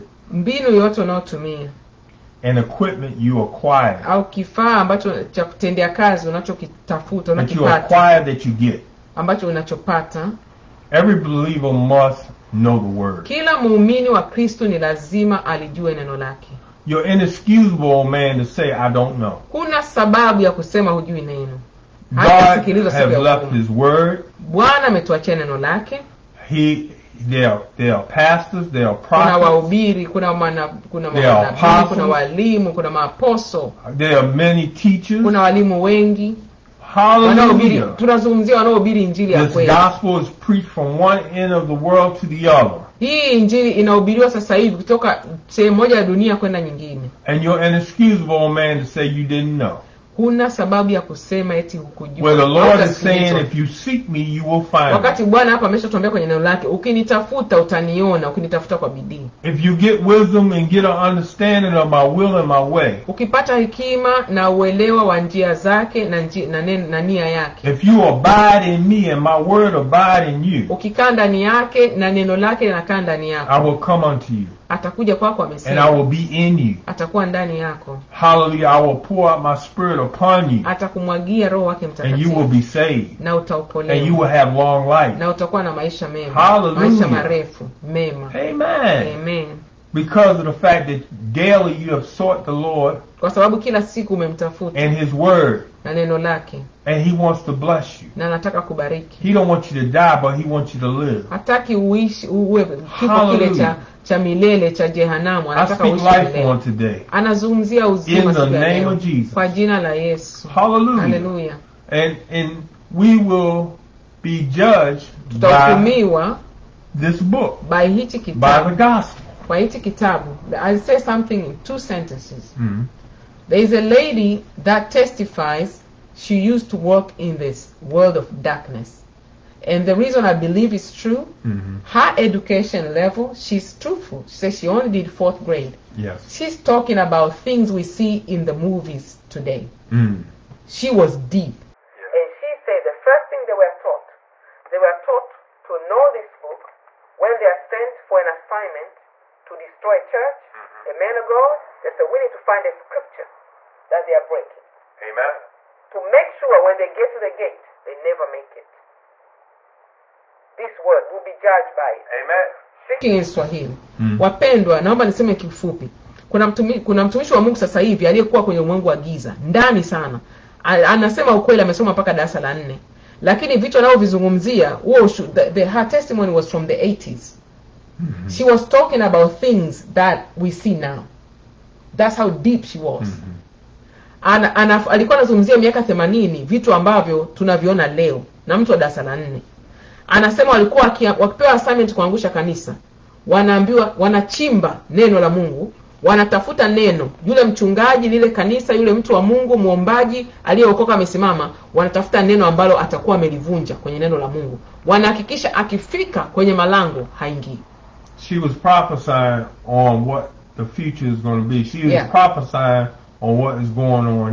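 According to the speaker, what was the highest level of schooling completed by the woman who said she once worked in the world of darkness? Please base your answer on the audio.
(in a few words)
fourth grade.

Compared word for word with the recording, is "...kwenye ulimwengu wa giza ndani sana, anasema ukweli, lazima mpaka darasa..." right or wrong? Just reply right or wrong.
wrong.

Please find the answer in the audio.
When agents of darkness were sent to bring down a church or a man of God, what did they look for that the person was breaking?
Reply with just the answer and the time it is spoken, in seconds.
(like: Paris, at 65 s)
a scripture, at 152 s.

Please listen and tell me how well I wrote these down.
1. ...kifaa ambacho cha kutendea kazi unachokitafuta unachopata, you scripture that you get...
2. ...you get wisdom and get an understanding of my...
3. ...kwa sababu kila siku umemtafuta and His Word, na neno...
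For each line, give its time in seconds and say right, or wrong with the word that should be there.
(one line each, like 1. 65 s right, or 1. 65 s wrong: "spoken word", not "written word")
1. 4 s wrong: "acquire", not "scripture"
2. 59 s right
3. 93 s right.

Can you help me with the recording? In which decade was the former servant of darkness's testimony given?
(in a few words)
the 80s.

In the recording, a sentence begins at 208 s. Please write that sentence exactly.
She was prophesying on what the future is going to be.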